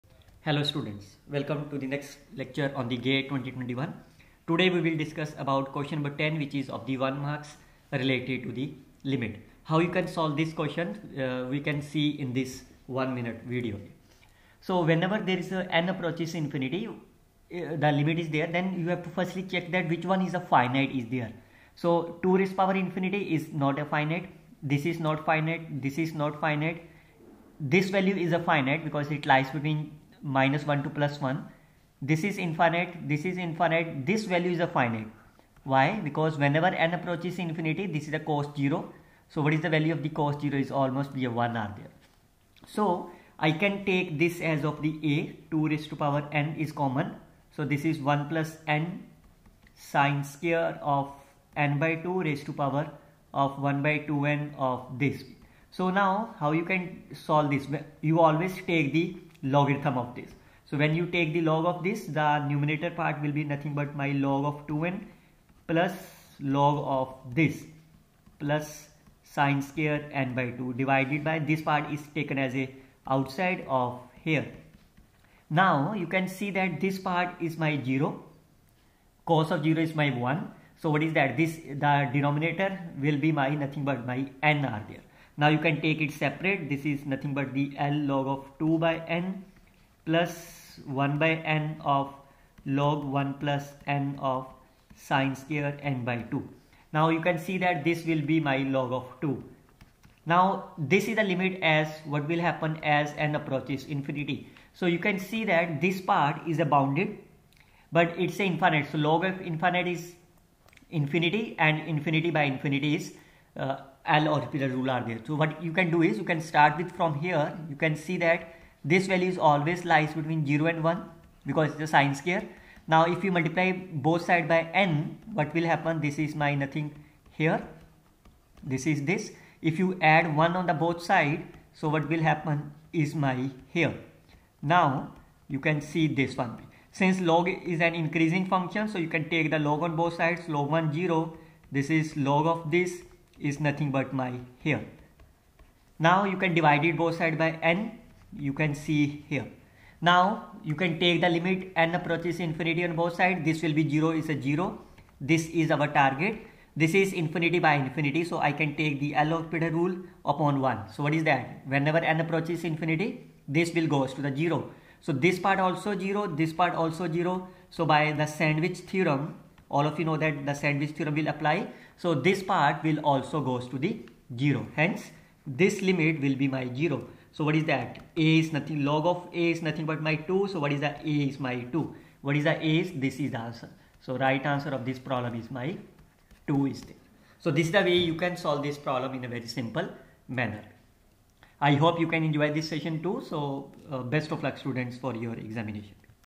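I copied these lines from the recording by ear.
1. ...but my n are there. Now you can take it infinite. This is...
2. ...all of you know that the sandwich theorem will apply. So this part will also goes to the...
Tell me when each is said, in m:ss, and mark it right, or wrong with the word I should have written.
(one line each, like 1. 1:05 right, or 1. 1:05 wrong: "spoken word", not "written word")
1. 1:23 wrong: "separate", not "infinite"
2. 2:49 right.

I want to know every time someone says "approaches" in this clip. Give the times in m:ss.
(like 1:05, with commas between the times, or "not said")
0:15, 0:36, 1:43, 2:31, 2:42.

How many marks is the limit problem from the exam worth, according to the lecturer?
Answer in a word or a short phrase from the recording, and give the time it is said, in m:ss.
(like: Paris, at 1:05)
1, at 0:06.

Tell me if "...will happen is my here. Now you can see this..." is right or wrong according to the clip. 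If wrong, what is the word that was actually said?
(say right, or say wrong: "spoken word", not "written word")
right.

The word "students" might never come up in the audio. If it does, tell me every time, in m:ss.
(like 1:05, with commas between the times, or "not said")
0:00, 3:14.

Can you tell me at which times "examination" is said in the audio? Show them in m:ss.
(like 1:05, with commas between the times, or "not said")
3:15.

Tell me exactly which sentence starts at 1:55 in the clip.
So what you can do is you can start with from here.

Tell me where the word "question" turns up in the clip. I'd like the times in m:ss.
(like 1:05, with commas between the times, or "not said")
0:05, 0:10.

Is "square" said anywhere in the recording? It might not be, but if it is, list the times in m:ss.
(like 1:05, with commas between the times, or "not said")
0:50, 1:09, 1:35, 2:02.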